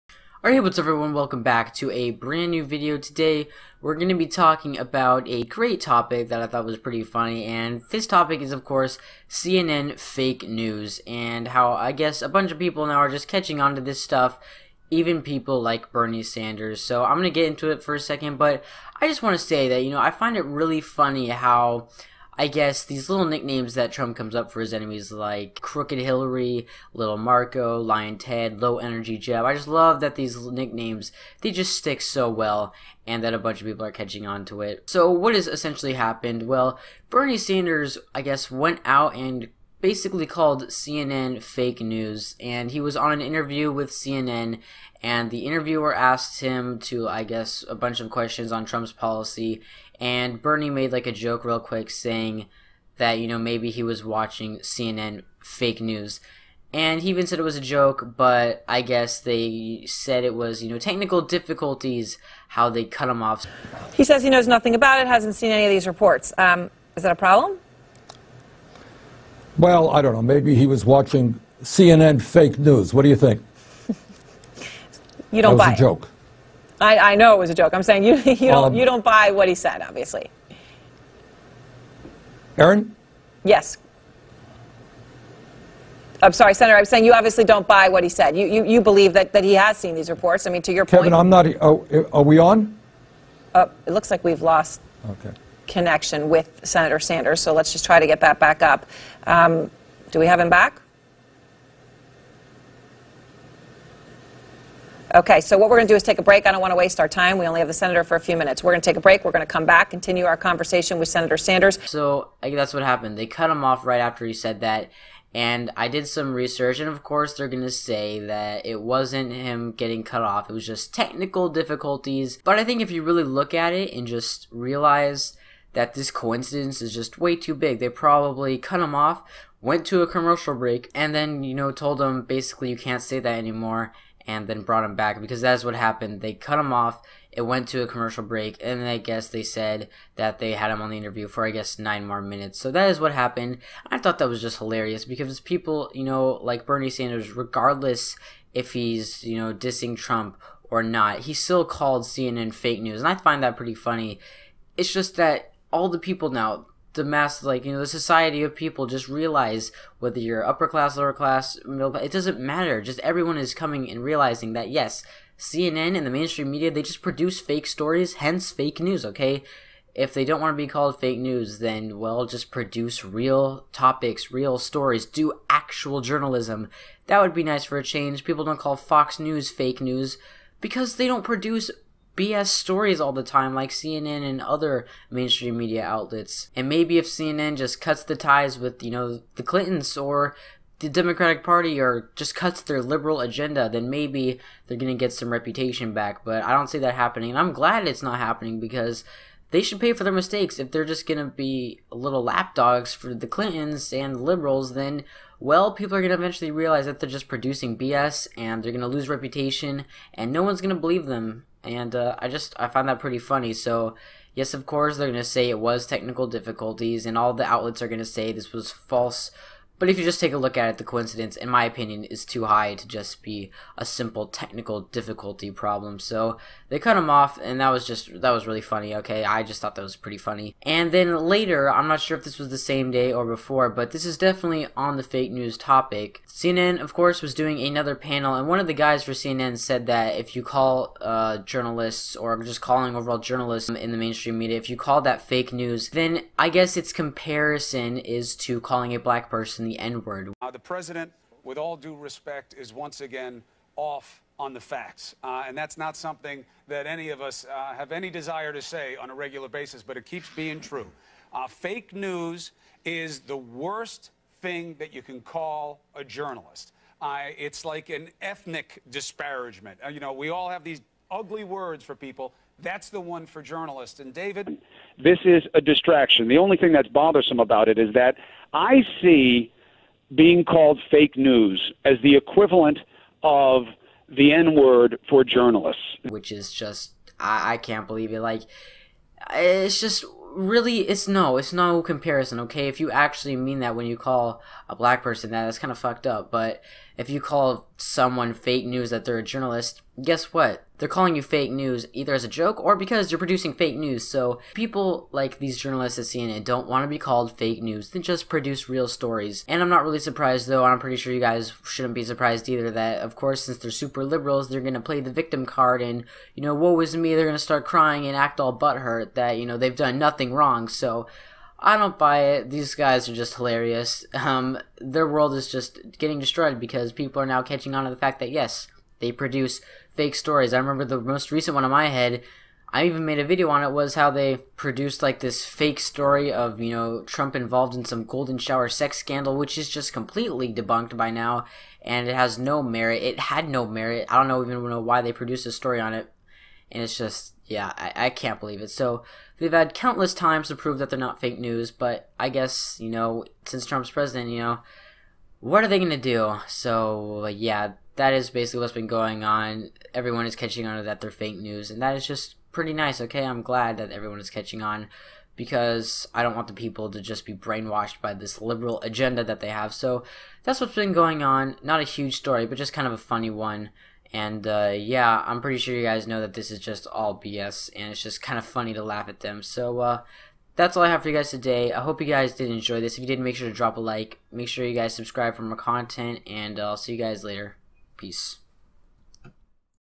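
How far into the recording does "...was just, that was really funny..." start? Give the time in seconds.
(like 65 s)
227 s.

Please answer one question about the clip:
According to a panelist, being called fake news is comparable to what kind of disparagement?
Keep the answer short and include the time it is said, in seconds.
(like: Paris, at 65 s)
ethnic disparagement, at 268 s.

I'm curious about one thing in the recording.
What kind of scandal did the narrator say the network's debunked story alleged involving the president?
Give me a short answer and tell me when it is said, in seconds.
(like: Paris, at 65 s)
golden shower sex scandal, at 338 s.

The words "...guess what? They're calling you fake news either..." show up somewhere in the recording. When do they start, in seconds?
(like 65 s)
300 s.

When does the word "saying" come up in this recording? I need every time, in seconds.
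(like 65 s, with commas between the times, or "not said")
51 s, 77 s, 86 s.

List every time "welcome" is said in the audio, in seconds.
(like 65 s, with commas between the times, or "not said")
1 s.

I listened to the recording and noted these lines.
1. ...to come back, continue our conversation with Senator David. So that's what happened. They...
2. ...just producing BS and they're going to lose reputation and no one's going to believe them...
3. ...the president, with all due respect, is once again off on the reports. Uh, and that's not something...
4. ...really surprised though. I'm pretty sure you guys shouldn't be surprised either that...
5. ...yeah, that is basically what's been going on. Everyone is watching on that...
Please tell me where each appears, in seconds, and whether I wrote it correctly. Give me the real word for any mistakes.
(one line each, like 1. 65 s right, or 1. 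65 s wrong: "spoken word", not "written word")
1. 109 s wrong: "Sanders", not "David"
2. 207 s right
3. 250 s wrong: "facts", not "reports"
4. 309 s right
5. 357 s wrong: "catching", not "watching".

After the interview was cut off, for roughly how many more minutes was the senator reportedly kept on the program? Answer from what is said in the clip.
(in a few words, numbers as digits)
9.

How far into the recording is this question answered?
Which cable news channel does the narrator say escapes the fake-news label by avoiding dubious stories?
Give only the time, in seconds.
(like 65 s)
178 s.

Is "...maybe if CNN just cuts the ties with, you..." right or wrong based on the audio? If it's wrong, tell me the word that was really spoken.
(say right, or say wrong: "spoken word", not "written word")
right.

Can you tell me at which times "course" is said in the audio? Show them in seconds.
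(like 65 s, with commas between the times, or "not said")
8 s, 117 s, 214 s, 236 s, 313 s.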